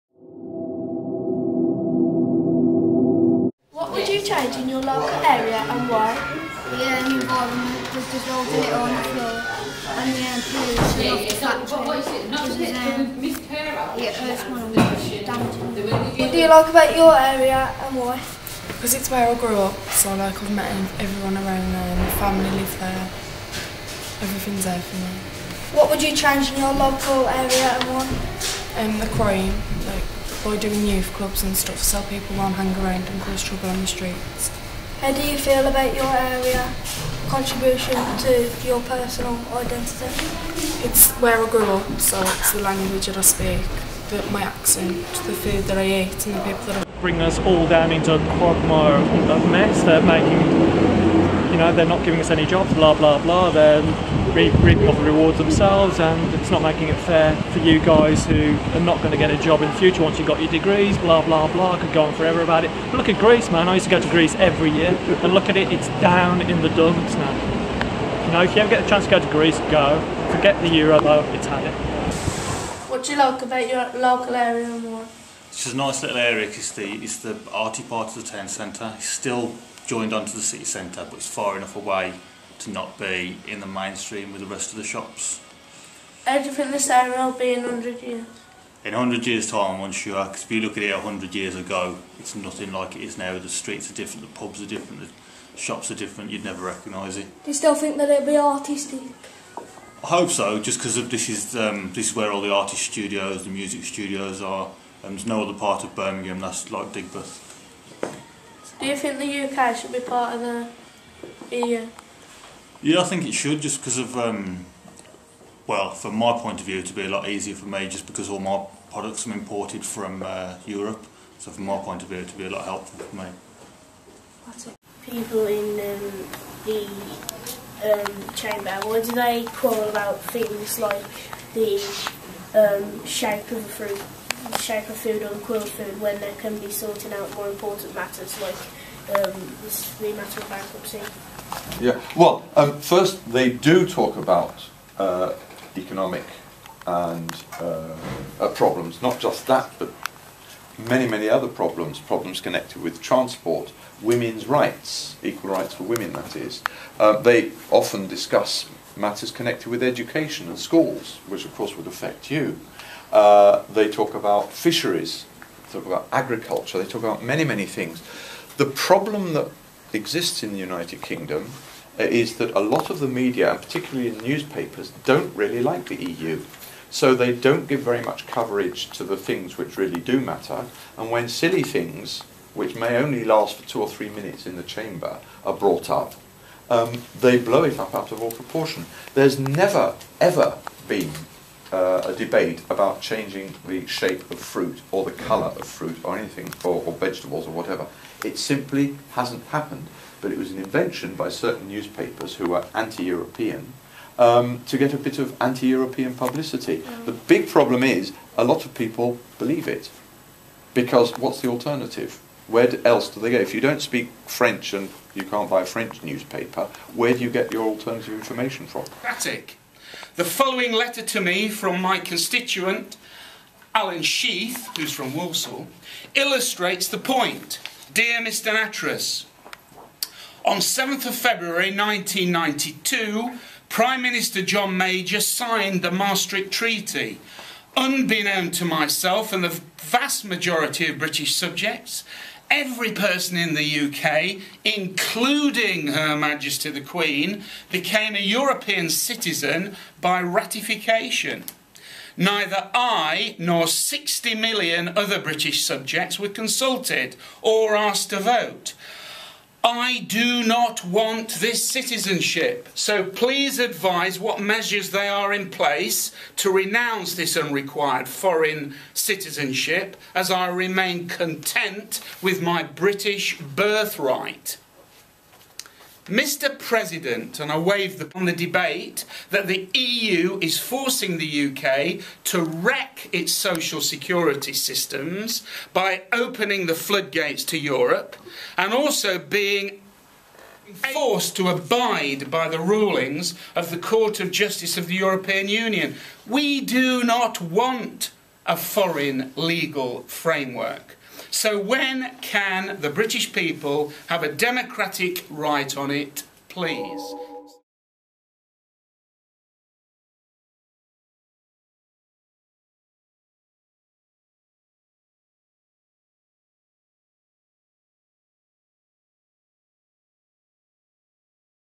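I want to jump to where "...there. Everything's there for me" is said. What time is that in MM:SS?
00:22.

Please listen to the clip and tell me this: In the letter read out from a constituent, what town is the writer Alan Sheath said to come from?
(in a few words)
Walsall.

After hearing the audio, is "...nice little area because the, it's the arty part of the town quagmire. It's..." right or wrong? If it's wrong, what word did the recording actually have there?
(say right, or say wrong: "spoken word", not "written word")
wrong: "centre", not "quagmire".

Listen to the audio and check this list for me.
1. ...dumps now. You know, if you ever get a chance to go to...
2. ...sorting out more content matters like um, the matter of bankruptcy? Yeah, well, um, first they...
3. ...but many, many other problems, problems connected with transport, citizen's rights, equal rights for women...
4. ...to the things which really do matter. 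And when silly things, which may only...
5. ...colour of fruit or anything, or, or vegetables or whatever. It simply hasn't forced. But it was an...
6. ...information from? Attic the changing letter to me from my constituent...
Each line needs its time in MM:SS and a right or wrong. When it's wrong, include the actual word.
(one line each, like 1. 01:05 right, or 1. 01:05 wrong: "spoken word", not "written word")
1. 01:06 right
2. 02:16 wrong: "important", not "content"
3. 02:29 wrong: "women", not "citizen"
4. 02:58 right
5. 03:15 wrong: "happened", not "forced"
6. 03:38 wrong: "following", not "changing".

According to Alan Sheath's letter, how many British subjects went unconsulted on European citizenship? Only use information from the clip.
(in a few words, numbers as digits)
60 million.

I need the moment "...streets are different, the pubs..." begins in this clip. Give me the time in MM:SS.
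01:33.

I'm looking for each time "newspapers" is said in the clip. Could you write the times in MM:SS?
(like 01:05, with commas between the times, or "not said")
02:54, 03:21, 03:36.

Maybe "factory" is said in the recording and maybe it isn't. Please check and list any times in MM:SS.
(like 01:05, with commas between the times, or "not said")
00:11.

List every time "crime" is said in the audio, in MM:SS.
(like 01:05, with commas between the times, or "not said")
00:29.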